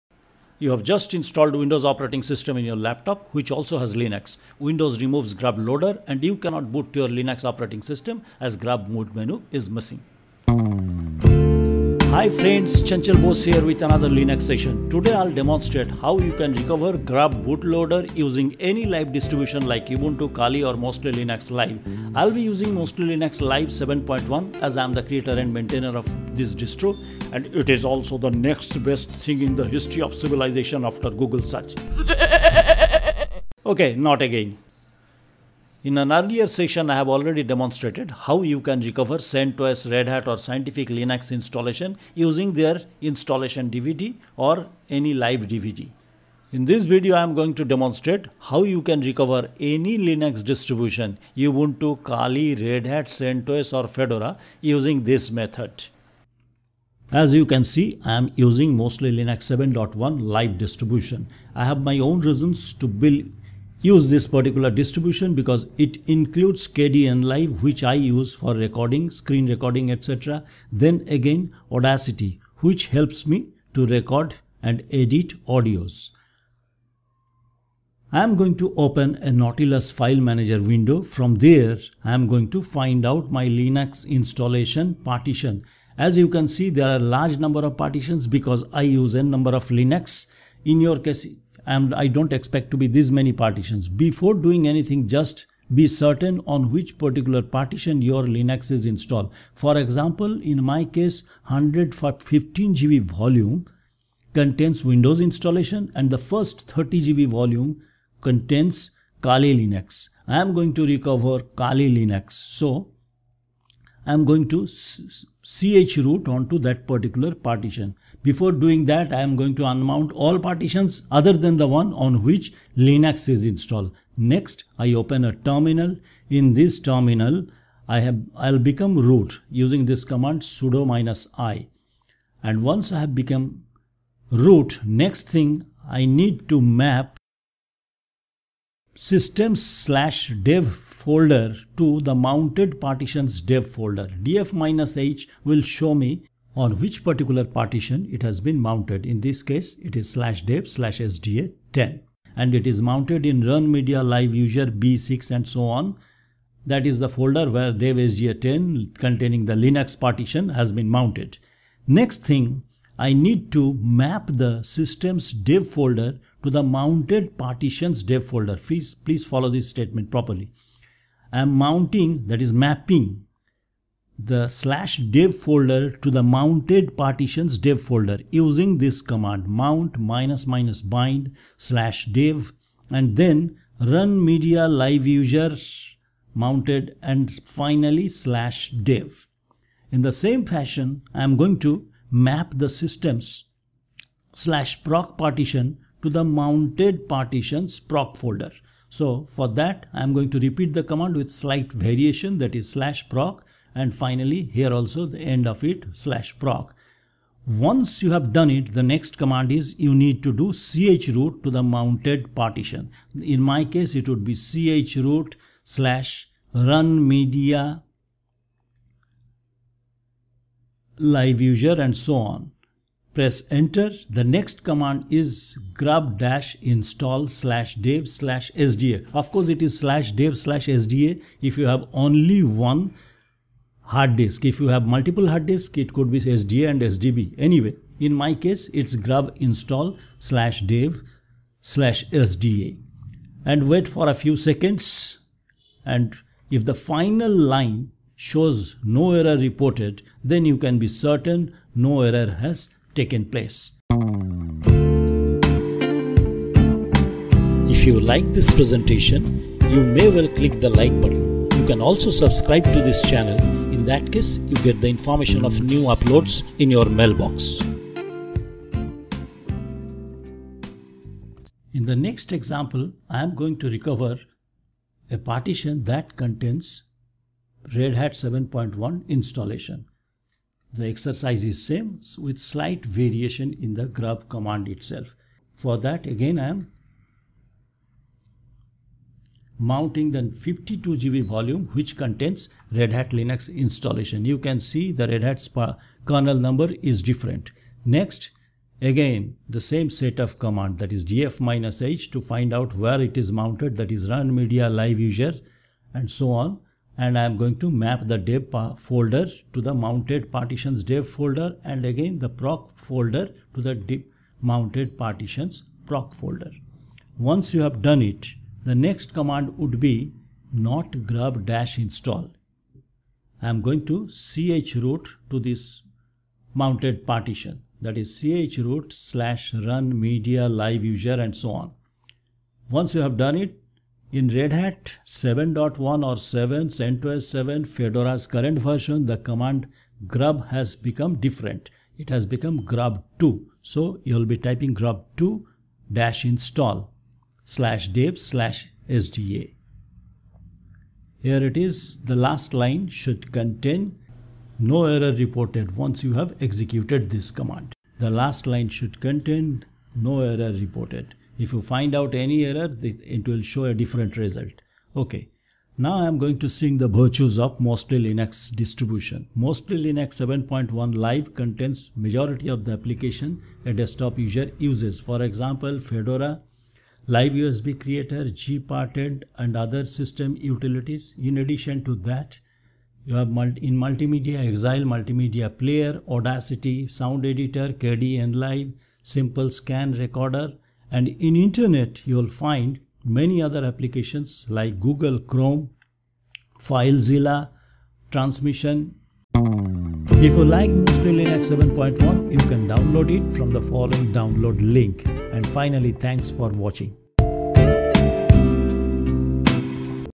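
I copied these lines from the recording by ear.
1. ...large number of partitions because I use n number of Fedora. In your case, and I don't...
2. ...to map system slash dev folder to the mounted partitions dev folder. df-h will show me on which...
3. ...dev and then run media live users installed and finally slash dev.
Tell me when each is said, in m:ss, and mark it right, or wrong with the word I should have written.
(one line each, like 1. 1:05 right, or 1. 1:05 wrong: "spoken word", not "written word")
1. 1:26 wrong: "Linux", not "Fedora"
2. 2:16 right
3. 3:02 wrong: "mounted", not "installed".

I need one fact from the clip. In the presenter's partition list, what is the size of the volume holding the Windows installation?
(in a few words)
115 GB.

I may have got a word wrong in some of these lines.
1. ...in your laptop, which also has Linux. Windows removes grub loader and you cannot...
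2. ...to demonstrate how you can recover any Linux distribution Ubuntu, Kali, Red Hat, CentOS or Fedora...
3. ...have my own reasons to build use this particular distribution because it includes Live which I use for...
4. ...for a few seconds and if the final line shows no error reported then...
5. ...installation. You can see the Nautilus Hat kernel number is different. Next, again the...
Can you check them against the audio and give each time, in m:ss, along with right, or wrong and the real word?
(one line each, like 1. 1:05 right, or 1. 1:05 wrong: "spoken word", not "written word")
1. 0:02 right
2. 0:47 right
3. 1:01 wrong: "Kdenlive", not "Live"
4. 4:03 right
5. 4:53 wrong: "Red", not "Nautilus".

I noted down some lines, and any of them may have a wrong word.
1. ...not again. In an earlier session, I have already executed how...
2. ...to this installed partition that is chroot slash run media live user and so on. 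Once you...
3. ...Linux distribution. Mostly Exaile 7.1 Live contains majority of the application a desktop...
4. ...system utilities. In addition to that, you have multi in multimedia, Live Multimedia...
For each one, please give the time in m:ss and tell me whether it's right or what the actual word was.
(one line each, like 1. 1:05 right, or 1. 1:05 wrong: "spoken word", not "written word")
1. 0:33 wrong: "demonstrated", not "executed"
2. 5:25 wrong: "mounted", not "installed"
3. 6:08 wrong: "Linux", not "Exaile"
4. 6:19 wrong: "Exaile", not "Live".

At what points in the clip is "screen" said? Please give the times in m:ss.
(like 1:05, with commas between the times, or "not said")
1:09, 6:29.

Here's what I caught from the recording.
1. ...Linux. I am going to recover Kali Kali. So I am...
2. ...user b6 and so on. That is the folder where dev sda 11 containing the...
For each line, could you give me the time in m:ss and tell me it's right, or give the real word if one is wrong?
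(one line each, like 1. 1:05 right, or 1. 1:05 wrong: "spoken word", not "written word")
1. 1:49 wrong: "Linux", not "Kali"
2. 2:34 wrong: "10", not "11".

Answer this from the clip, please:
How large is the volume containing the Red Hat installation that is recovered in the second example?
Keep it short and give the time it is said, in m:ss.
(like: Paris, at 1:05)
52 GB, at 4:50.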